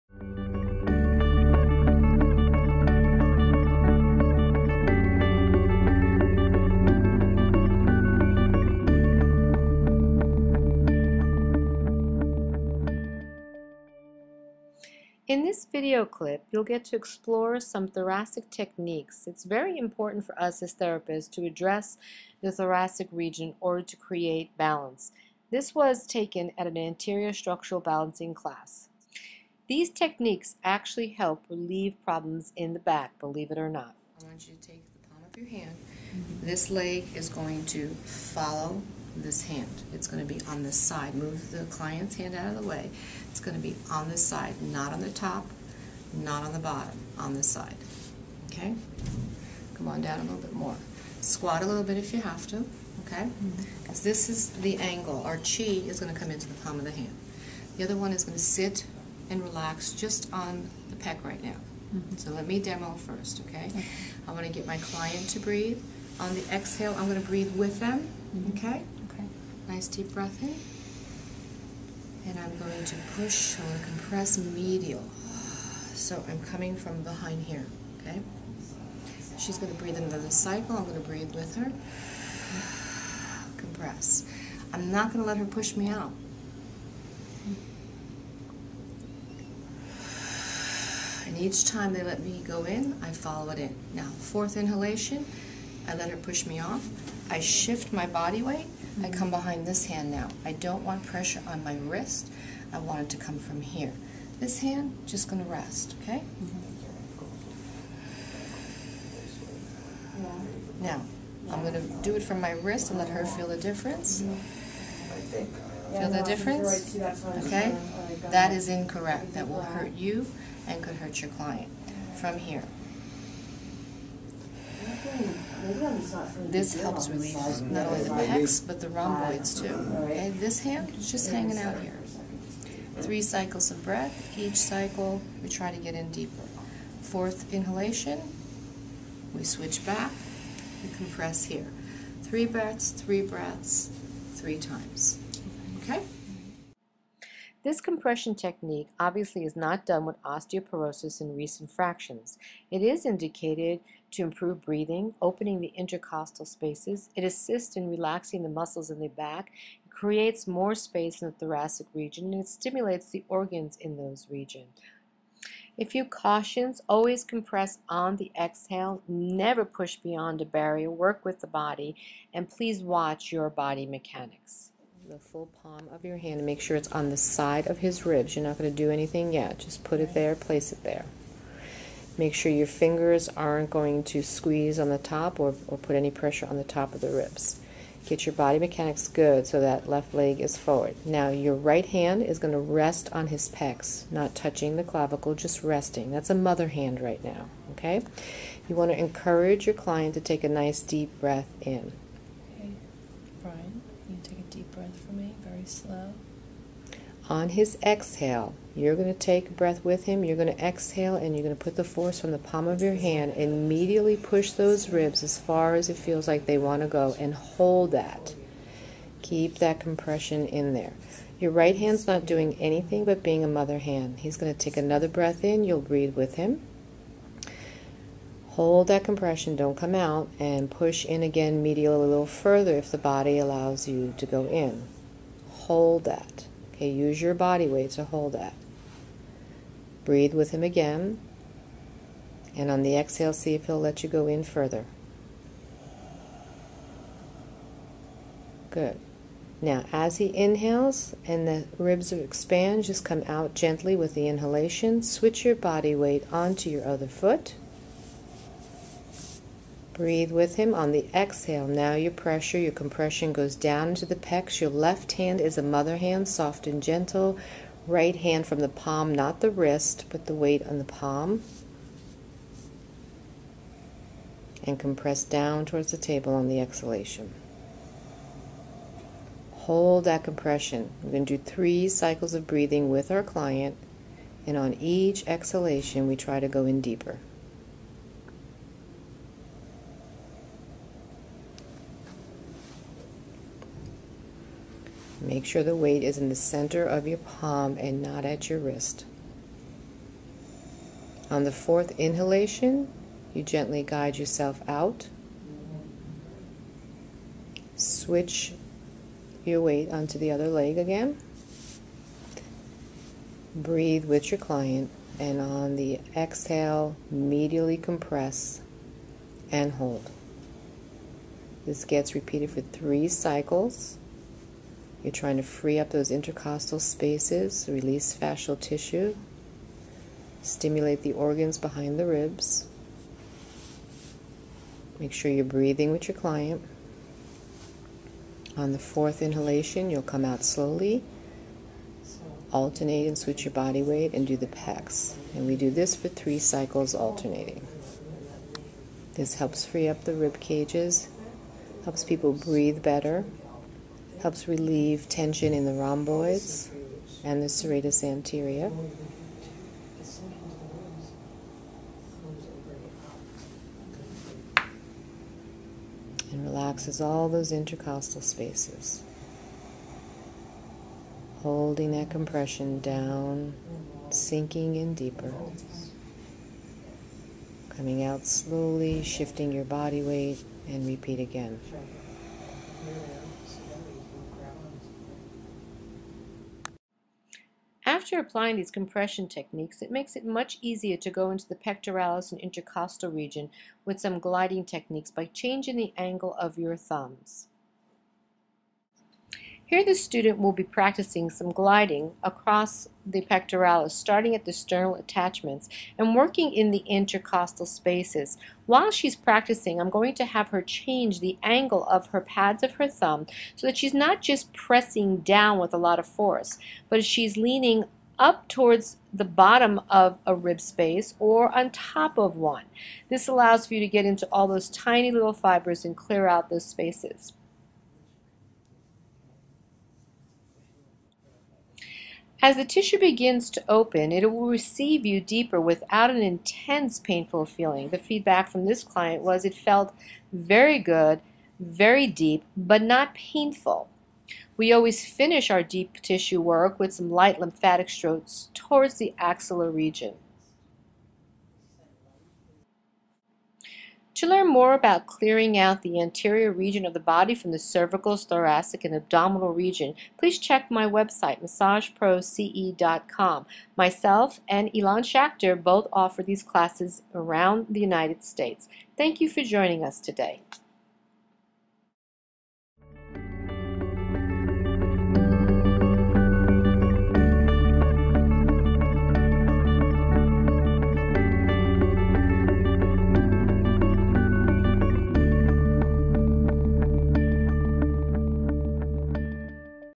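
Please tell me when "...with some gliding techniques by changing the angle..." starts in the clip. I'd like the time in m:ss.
6:33.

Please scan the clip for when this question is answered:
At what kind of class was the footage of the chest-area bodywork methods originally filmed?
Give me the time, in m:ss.
0:26.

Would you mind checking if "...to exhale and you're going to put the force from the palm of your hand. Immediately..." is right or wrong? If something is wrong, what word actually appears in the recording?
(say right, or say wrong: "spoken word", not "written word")
right.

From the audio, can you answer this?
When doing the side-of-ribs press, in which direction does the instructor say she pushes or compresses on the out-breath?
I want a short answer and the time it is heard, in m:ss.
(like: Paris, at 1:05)
medial, at 1:14.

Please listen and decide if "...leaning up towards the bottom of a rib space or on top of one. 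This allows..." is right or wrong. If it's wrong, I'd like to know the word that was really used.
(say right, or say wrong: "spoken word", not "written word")
right.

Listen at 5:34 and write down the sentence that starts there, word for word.
Make sure you're breathing with your client.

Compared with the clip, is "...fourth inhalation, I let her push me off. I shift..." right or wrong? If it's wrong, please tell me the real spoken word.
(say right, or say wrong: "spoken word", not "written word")
right.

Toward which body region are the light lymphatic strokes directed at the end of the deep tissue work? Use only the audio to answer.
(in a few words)
axillary region.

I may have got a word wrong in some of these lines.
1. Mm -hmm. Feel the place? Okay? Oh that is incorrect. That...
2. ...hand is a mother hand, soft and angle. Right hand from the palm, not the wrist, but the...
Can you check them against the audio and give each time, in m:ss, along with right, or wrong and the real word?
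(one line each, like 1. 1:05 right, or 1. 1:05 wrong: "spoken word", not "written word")
1. 1:54 wrong: "difference", not "place"
2. 4:25 wrong: "gentle", not "angle".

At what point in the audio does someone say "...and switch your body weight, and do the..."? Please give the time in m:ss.
5:43.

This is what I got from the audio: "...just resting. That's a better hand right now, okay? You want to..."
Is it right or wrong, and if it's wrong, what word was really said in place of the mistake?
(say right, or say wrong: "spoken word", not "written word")
wrong: "mother", not "better".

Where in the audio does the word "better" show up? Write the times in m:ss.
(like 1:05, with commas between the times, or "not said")
5:52.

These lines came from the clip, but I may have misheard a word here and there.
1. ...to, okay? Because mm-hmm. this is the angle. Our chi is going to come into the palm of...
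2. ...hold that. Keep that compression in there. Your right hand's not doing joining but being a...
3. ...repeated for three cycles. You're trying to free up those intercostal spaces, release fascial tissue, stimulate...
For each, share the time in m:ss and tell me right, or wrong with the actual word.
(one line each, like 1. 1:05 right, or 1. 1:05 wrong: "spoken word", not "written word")
1. 0:52 right
2. 3:37 wrong: "anything", not "joining"
3. 5:22 right.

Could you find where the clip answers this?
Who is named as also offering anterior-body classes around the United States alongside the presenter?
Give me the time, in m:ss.
7:44.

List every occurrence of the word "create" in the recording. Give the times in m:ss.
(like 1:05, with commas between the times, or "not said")
0:23, 2:39.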